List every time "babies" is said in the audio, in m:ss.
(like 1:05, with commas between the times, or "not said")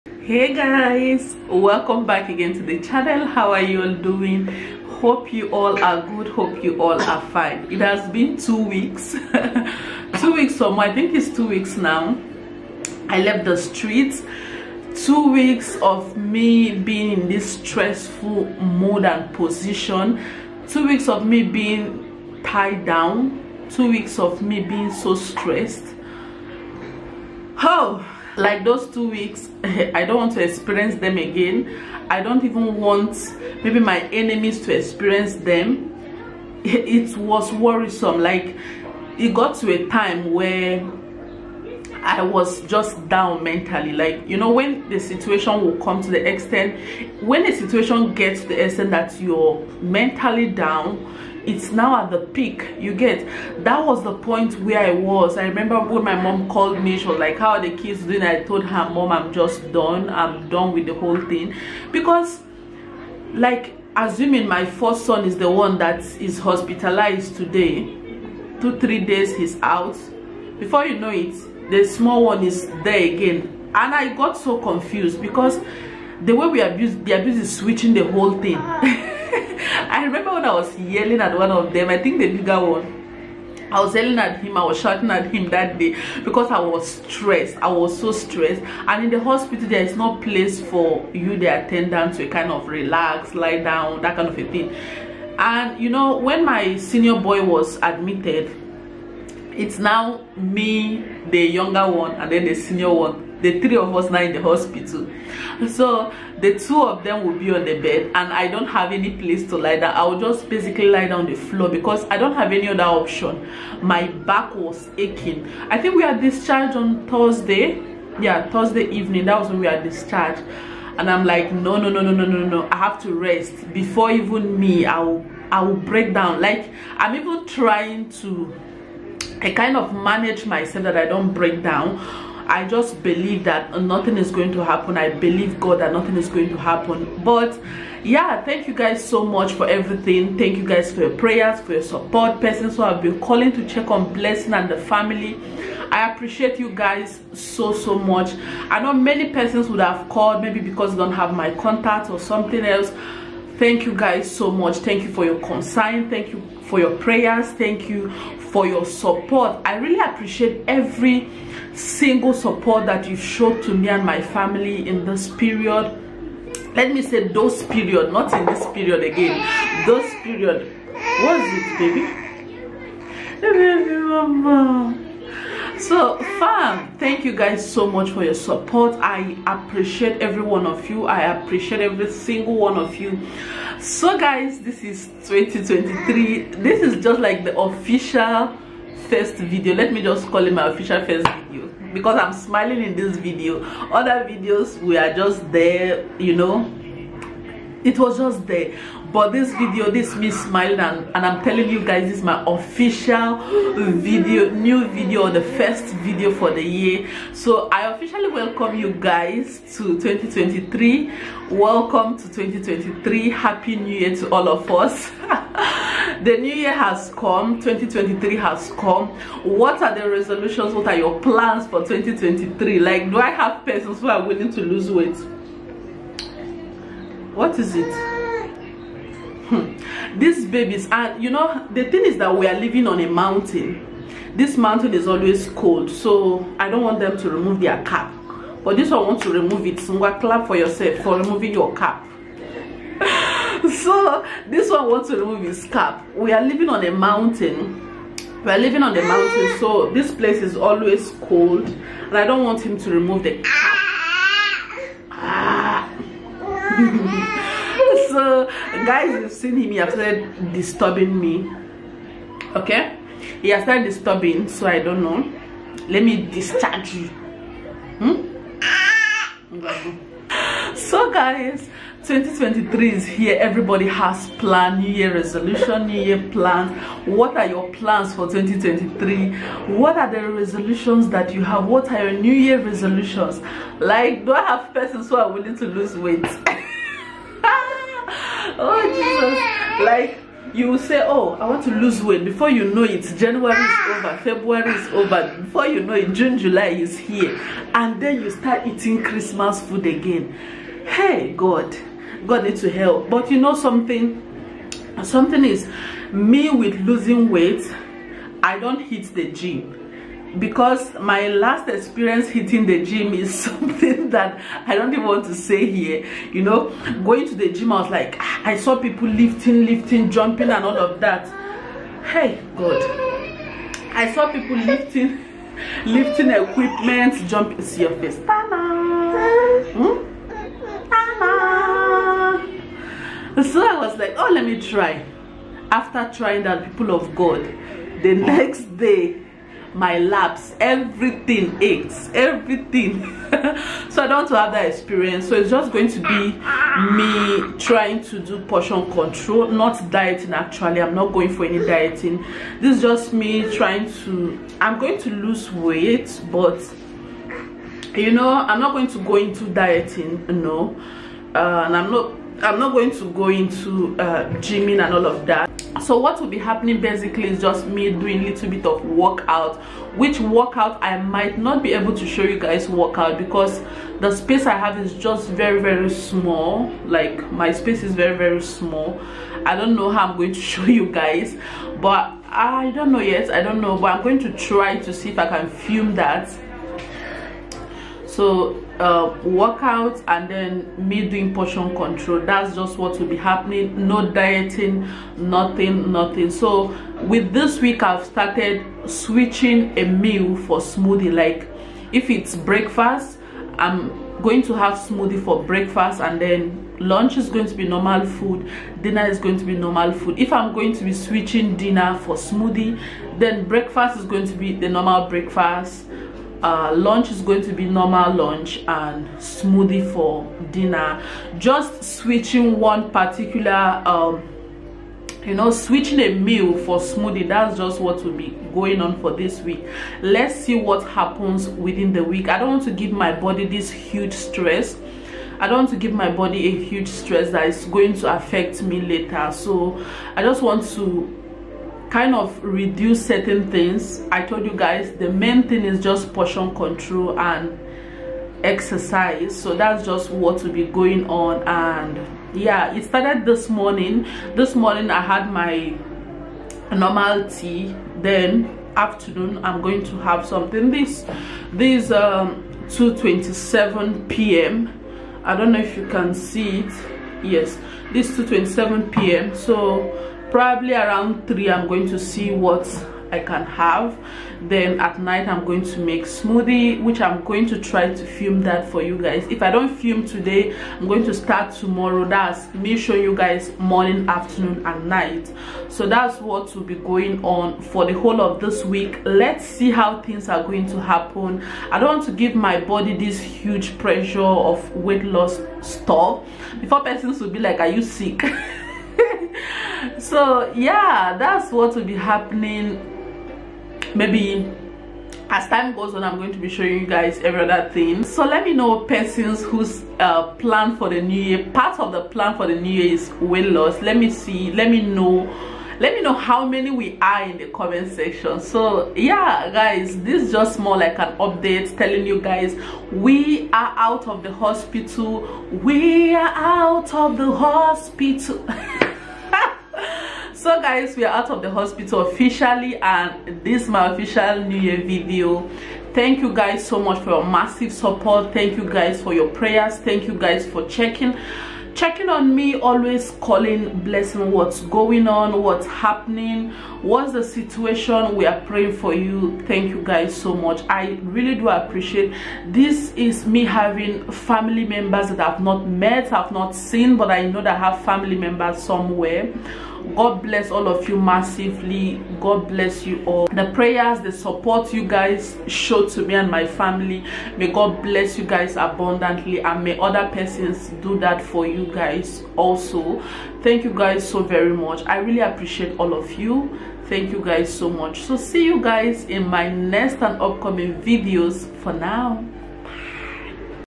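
3:50.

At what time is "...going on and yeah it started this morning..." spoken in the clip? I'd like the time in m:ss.
7:30.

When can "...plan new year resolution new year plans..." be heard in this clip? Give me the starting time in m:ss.
4:34.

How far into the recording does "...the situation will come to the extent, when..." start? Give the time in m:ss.
0:44.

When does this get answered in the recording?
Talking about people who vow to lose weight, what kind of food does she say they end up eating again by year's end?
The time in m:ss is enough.
4:59.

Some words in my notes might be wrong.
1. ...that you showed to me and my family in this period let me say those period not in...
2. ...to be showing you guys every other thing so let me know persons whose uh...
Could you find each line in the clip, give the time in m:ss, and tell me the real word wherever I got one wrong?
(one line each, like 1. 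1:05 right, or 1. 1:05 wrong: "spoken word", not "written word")
1. 2:42 right
2. 8:26 right.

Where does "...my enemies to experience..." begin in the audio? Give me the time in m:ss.
0:33.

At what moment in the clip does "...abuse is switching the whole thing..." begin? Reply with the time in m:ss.
1:17.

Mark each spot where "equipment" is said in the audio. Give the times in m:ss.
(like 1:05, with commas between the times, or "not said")
5:26.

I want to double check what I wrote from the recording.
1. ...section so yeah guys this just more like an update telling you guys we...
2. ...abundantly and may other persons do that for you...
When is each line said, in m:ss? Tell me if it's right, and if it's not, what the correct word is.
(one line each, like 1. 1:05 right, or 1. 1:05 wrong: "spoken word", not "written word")
1. 8:37 right
2. 9:28 right.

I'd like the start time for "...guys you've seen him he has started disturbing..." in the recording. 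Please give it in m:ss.
4:18.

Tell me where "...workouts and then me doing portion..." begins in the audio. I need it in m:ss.
6:29.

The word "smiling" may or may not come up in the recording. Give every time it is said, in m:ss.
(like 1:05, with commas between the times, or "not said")
3:12, 3:20.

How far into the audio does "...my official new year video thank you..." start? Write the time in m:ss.
8:53.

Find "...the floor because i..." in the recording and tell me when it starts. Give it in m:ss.
1:51.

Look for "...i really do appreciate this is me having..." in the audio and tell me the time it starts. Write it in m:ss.
9:10.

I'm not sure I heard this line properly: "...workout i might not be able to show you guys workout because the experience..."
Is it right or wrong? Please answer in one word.
wrong.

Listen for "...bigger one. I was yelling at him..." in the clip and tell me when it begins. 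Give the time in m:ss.
1:22.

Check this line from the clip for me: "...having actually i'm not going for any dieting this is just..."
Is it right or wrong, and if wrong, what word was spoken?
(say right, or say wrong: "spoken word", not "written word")
wrong: "dieting", not "having".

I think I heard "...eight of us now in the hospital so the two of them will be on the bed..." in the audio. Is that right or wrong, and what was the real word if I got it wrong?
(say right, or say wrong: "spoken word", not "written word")
wrong: "three", not "eight".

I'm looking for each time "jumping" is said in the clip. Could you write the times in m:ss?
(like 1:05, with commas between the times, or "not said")
5:20, 5:27.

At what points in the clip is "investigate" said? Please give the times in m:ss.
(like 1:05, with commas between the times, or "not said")
not said.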